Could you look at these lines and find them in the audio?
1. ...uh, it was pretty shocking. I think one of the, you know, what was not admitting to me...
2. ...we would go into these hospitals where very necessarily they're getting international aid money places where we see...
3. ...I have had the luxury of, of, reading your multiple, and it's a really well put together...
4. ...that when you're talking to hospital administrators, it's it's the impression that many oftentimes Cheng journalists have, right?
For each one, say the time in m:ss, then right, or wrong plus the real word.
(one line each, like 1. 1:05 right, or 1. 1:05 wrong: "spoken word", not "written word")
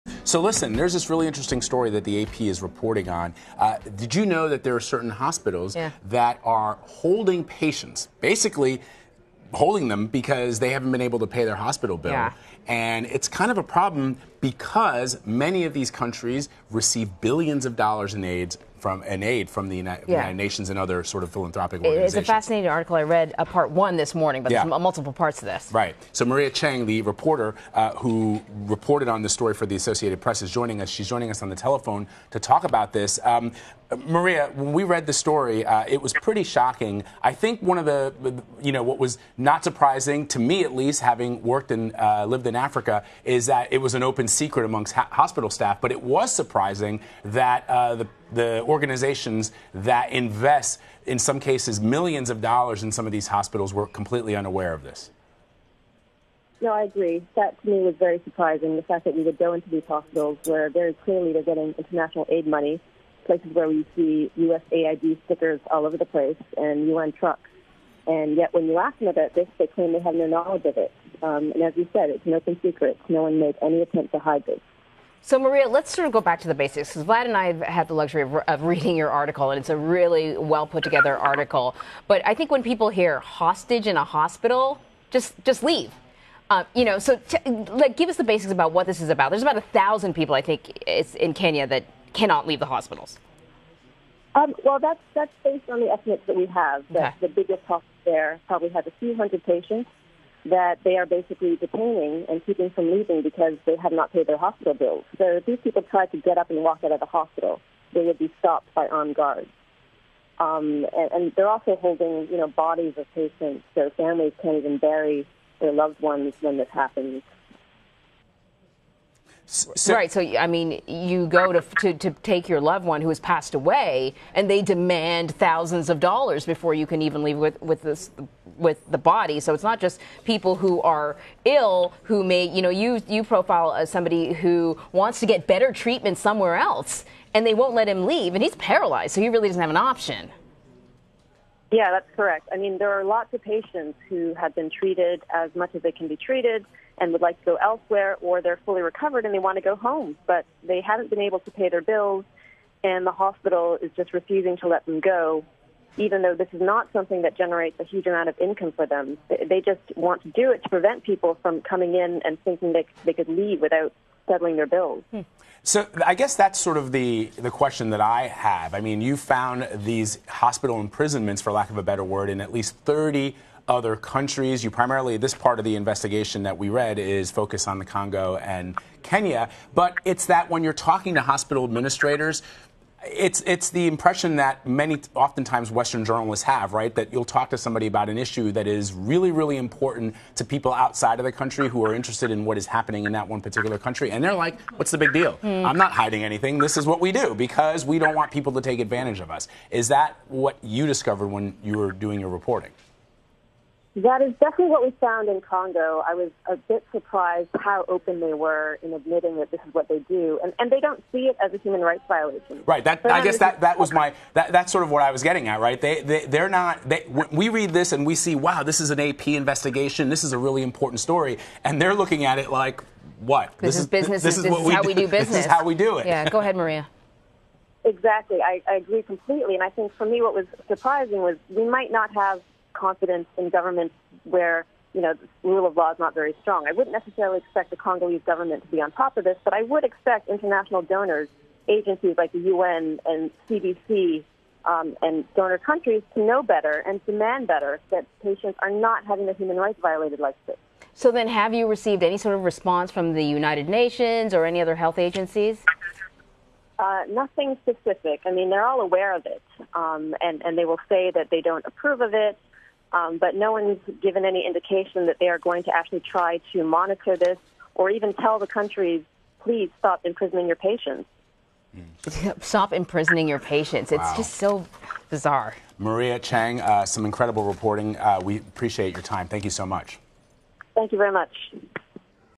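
1. 0:35 wrong: "surprising", not "admitting"
2. 0:59 wrong: "clearly", not "necessarily"
3. 1:17 wrong: "article", not "multiple"
4. 3:00 wrong: "Western", not "Cheng".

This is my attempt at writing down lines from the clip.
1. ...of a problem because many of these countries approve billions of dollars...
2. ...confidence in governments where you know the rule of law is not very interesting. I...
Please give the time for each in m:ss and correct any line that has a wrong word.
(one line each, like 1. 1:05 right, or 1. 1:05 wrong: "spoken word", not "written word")
1. 0:13 wrong: "receive", not "approve"
2. 3:52 wrong: "strong", not "interesting".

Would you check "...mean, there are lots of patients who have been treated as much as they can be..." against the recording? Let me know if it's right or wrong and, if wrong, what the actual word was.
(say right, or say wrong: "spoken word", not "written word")
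right.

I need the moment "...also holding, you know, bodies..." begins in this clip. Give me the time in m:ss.
1:51.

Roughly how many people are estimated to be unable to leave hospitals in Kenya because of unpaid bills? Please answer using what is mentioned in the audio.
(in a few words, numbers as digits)
1000.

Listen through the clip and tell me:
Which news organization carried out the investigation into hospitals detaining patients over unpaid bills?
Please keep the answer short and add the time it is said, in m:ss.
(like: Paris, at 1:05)
Associated Press, at 0:29.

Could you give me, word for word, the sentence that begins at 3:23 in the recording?
That is definitely what we found in Congo.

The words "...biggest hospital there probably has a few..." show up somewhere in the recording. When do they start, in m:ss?
1:37.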